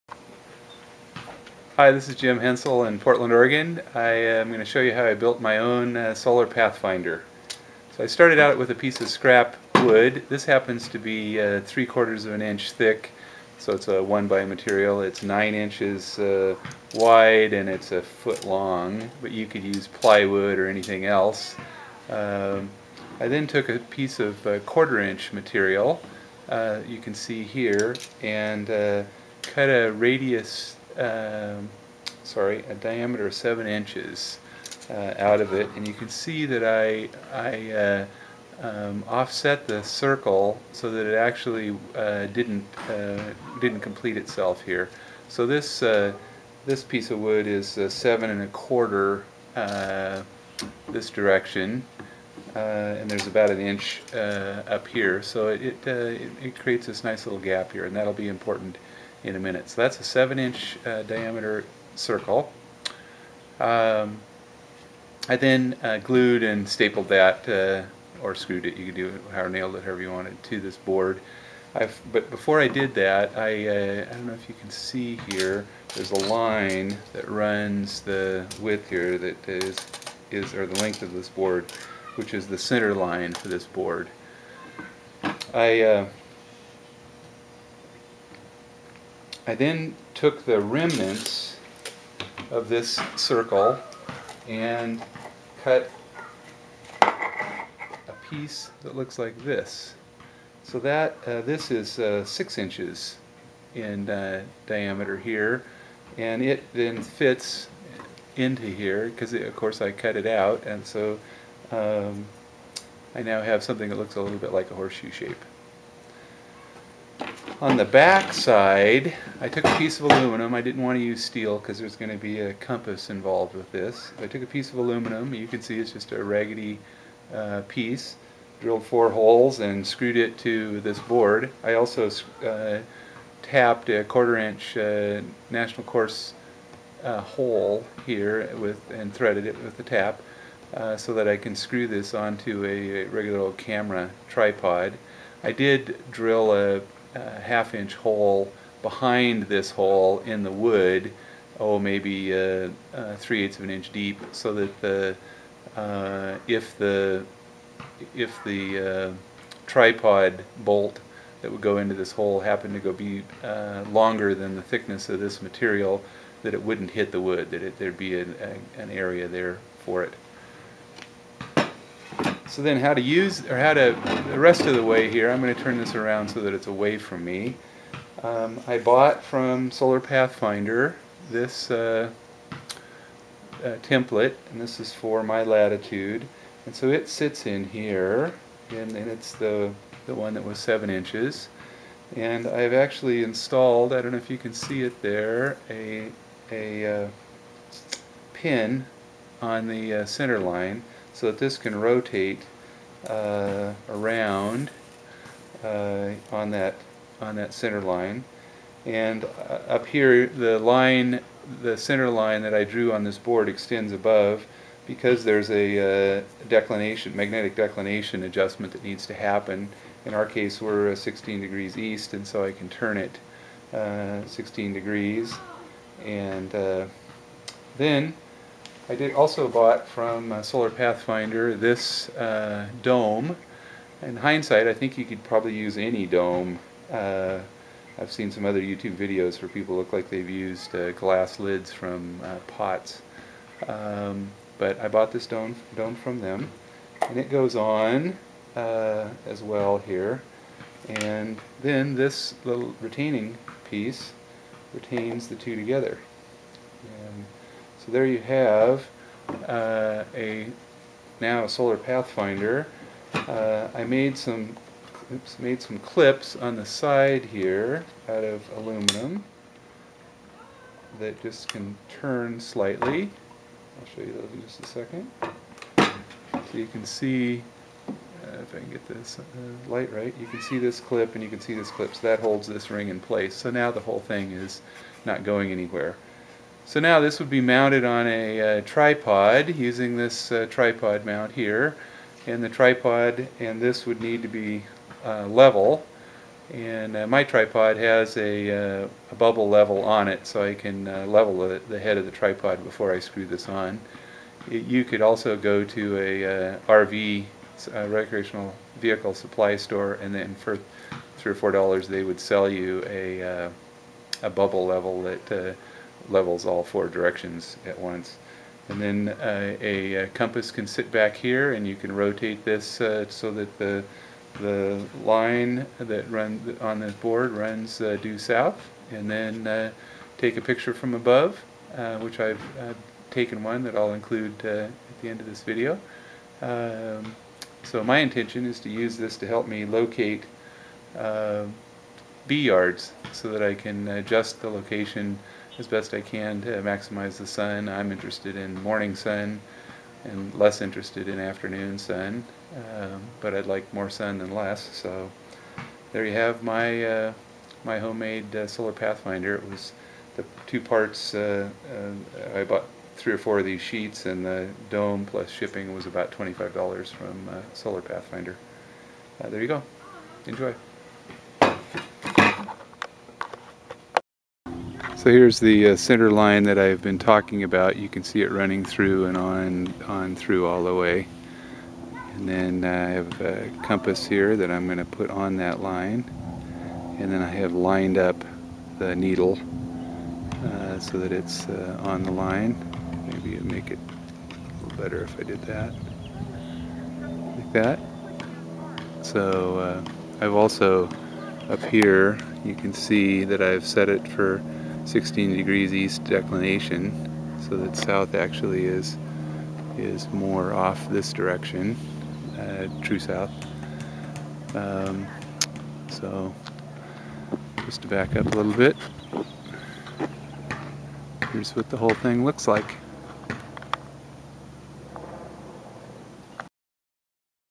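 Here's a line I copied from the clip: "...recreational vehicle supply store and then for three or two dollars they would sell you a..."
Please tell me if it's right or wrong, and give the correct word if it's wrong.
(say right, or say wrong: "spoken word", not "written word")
wrong: "four", not "two".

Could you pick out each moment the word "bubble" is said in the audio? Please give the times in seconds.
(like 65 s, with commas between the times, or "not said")
299 s, 314 s.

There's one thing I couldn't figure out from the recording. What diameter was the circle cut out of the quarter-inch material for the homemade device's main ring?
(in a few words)
7 inches.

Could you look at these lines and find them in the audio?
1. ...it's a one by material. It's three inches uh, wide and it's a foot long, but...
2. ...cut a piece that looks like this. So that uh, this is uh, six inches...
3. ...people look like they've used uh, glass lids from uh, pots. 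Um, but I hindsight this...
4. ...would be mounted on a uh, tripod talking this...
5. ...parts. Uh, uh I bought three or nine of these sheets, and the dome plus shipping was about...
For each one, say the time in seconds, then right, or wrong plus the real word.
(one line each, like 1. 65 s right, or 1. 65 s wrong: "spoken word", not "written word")
1. 13 s wrong: "nine", not "three"
2. 95 s right
3. 239 s wrong: "bought", not "hindsight"
4. 287 s wrong: "using", not "talking"
5. 360 s wrong: "four", not "nine".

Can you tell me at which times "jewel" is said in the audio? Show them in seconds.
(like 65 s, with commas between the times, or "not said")
not said.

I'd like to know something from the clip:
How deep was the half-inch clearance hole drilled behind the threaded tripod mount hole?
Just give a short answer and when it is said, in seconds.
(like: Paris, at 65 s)
3/8 of an inch, at 153 s.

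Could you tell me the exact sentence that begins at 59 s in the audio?
So that's a 7 inch uh, diameter circle.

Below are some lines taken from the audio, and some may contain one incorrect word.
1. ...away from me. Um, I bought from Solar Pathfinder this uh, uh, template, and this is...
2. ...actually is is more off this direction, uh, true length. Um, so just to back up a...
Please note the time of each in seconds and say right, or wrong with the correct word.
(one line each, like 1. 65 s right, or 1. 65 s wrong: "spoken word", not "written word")
1. 176 s right
2. 408 s wrong: "south", not "length".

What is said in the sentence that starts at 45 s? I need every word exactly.
So this, uh, this piece of wood is uh, 7 and a quarter this direction.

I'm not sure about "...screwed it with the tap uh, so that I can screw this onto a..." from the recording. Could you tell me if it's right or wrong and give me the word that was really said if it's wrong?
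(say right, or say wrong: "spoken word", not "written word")
wrong: "threaded", not "screwed".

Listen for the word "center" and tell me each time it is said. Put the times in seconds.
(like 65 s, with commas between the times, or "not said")
82 s, 200 s, 207 s, 211 s, 375 s.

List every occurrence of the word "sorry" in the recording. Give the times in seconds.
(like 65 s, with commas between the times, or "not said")
32 s.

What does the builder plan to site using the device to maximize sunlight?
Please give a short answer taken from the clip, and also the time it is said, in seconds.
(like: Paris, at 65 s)
Bee yards, at 342 s.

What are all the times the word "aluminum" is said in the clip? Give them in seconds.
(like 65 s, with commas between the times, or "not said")
120 s, 124 s, 268 s.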